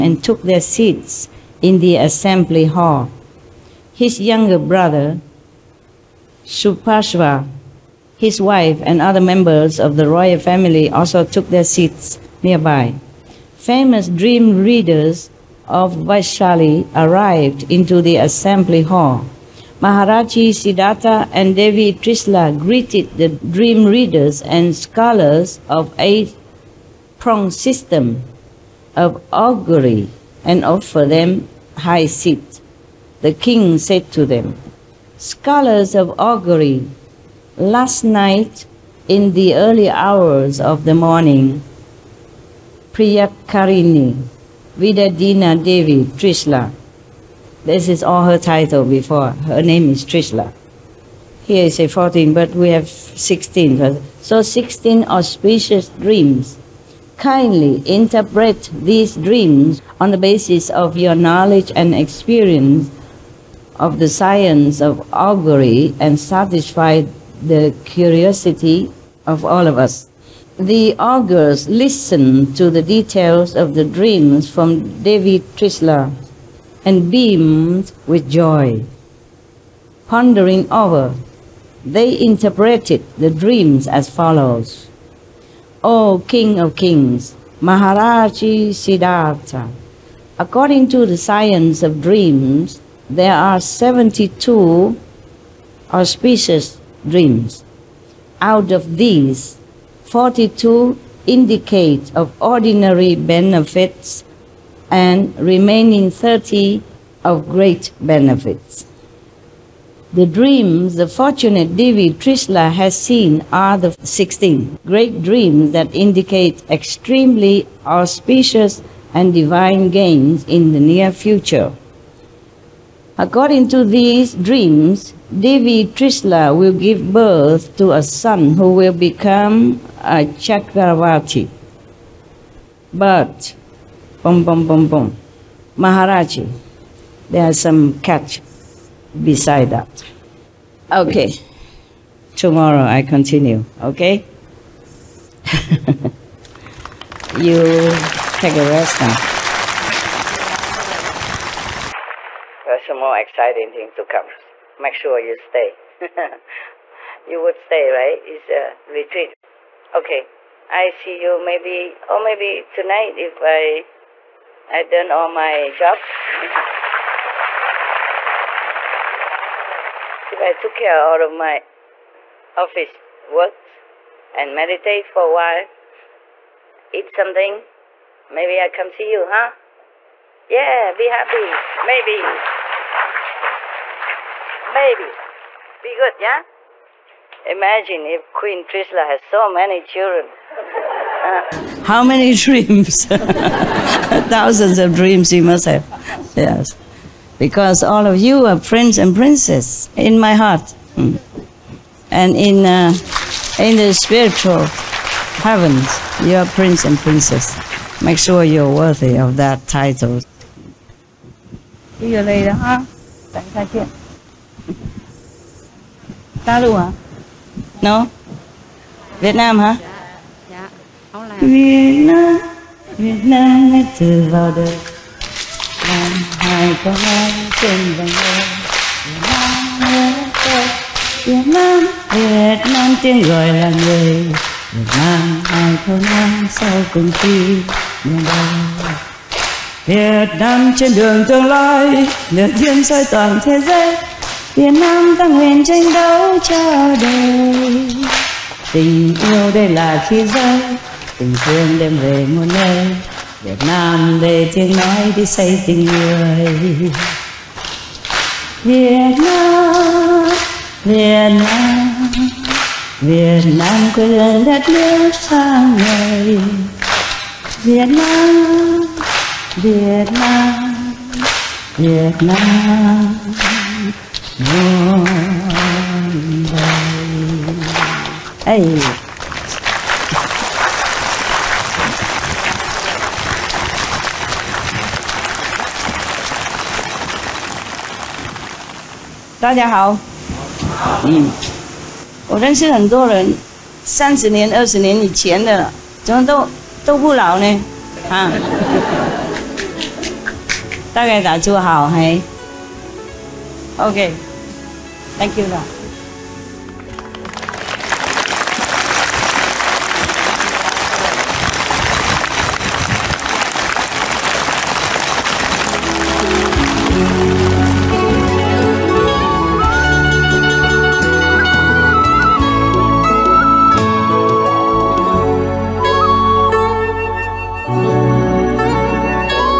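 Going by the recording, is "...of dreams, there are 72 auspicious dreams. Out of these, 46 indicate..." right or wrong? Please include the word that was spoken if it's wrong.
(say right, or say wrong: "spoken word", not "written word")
wrong: "42", not "46".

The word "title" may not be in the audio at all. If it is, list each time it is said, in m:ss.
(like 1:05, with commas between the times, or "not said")
0:48, 3:29.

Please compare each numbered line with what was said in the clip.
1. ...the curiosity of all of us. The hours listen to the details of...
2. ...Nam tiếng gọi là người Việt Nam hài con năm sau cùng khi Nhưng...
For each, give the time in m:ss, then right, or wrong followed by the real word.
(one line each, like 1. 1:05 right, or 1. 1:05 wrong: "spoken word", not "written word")
1. 1:07 wrong: "augurs", not "hours"
2. 3:52 right.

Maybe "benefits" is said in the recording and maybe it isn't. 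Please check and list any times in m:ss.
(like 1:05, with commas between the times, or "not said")
1:43, 1:48.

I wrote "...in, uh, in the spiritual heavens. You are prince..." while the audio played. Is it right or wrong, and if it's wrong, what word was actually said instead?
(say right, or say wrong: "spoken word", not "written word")
right.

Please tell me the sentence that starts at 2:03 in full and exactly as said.
According to these dreams, Devi Trishla will give birth to a son who will become a Chakravarti.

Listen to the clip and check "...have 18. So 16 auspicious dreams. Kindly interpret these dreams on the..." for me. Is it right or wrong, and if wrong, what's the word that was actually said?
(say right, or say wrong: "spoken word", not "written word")
wrong: "16", not "18".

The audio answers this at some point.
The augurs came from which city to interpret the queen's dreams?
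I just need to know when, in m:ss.
0:15.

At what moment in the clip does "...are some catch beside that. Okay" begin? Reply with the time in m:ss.
2:17.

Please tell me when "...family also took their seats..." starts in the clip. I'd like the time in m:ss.
0:10.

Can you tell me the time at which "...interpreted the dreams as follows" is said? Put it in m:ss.
1:22.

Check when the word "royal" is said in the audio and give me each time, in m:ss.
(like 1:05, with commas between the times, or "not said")
0:10.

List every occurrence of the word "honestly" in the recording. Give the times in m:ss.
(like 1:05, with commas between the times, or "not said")
not said.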